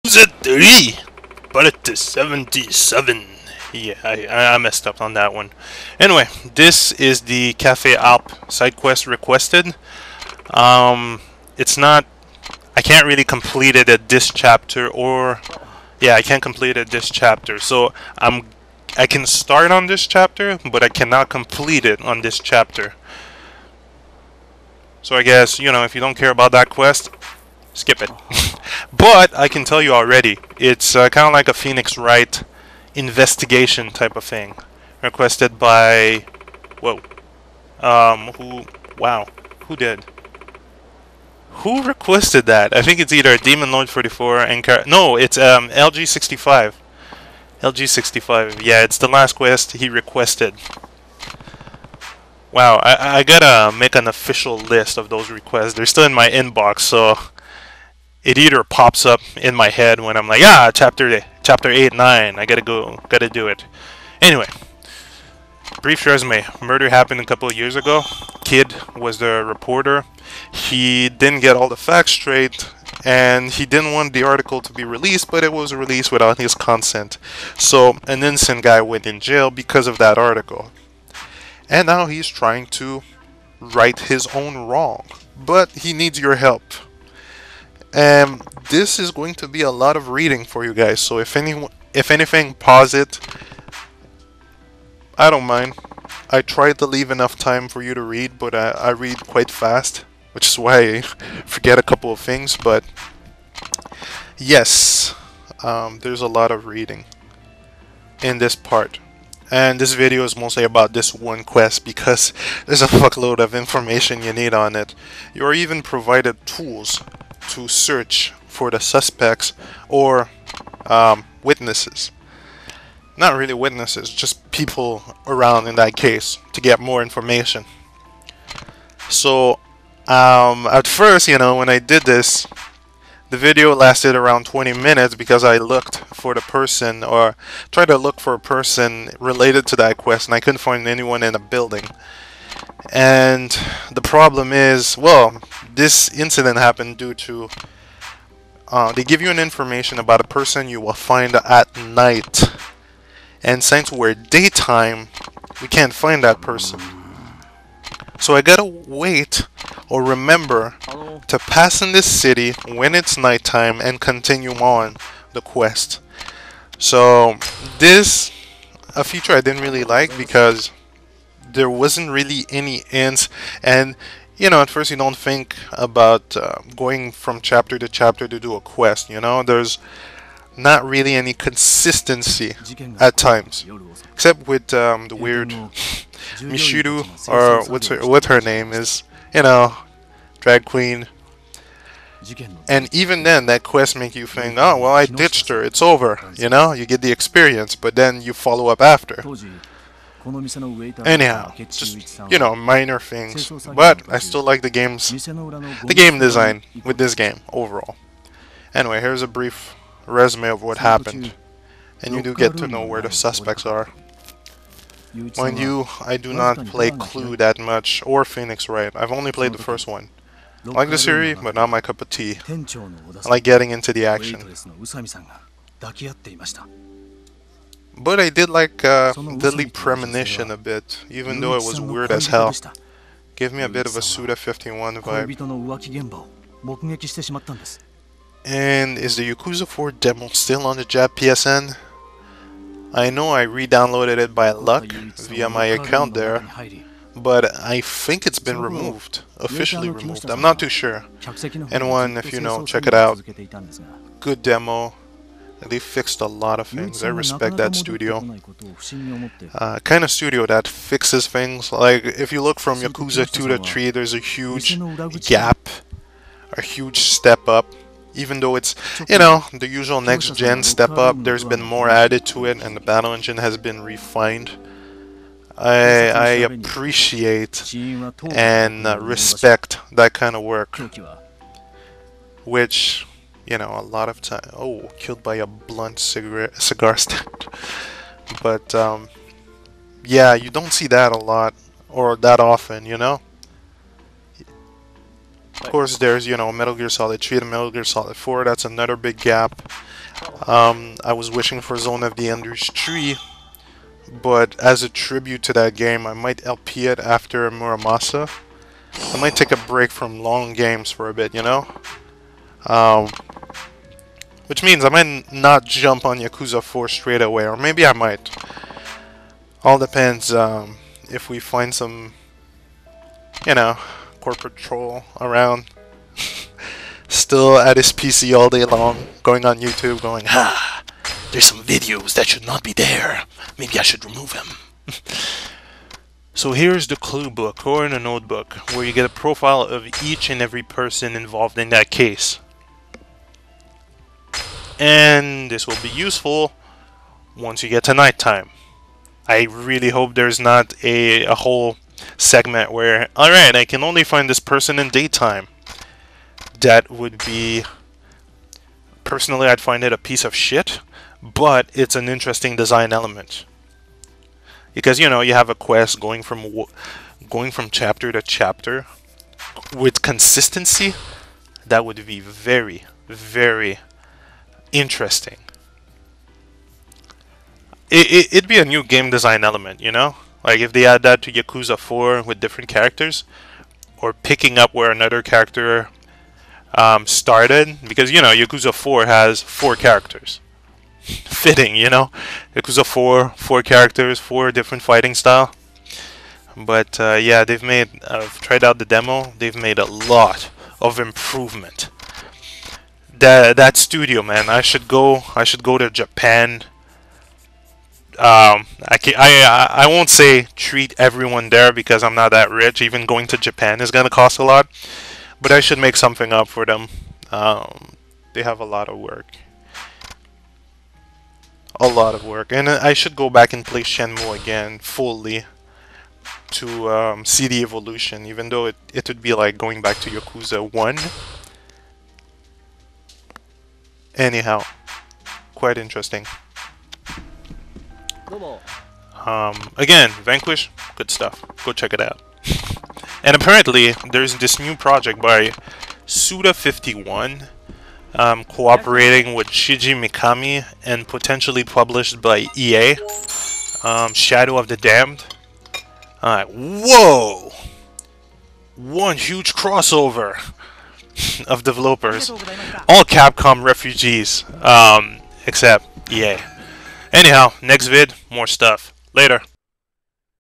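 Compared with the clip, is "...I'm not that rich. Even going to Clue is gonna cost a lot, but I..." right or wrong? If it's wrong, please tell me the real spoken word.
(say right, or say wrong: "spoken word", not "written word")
wrong: "Japan", not "Clue".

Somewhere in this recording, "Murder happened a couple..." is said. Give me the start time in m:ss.
1:06.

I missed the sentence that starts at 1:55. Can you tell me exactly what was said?
You're even provided tools to search for the suspects or um, witnesses.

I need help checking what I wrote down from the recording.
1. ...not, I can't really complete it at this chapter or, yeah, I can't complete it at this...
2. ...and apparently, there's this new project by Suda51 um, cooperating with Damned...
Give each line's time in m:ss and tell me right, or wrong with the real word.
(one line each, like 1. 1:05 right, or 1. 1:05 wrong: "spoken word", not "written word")
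1. 0:11 right
2. 7:23 wrong: "Shinji", not "Damned".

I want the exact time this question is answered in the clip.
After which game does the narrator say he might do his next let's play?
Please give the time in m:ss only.
5:07.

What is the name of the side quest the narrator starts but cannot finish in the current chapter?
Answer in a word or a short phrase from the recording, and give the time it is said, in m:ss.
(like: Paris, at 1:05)
Cafe Alp, at 0:07.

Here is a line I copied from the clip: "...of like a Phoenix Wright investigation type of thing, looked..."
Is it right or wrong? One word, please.
wrong.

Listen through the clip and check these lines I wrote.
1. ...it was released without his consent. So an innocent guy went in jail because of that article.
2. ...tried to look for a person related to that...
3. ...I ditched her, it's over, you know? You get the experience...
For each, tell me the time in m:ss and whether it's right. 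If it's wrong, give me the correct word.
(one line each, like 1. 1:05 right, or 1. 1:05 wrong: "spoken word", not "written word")
1. 1:15 right
2. 2:17 right
3. 3:14 right.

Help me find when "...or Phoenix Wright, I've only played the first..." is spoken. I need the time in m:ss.
3:38.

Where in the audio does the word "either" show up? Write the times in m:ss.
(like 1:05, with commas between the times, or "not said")
0:43, 0:58.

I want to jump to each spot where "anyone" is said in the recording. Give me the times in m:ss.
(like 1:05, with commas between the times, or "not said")
2:20, 4:11.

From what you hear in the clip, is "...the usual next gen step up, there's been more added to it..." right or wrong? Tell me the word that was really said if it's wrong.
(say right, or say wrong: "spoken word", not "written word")
right.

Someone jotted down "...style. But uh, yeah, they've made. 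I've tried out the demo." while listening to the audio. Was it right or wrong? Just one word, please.
right.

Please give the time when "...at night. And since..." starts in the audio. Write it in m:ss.
2:31.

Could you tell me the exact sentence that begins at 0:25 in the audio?
So I guess, you know, if you don't care about that quest, skip it.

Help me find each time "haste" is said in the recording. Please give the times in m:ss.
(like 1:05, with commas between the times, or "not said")
not said.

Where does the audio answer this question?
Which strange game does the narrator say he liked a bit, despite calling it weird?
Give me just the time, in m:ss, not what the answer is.
3:49.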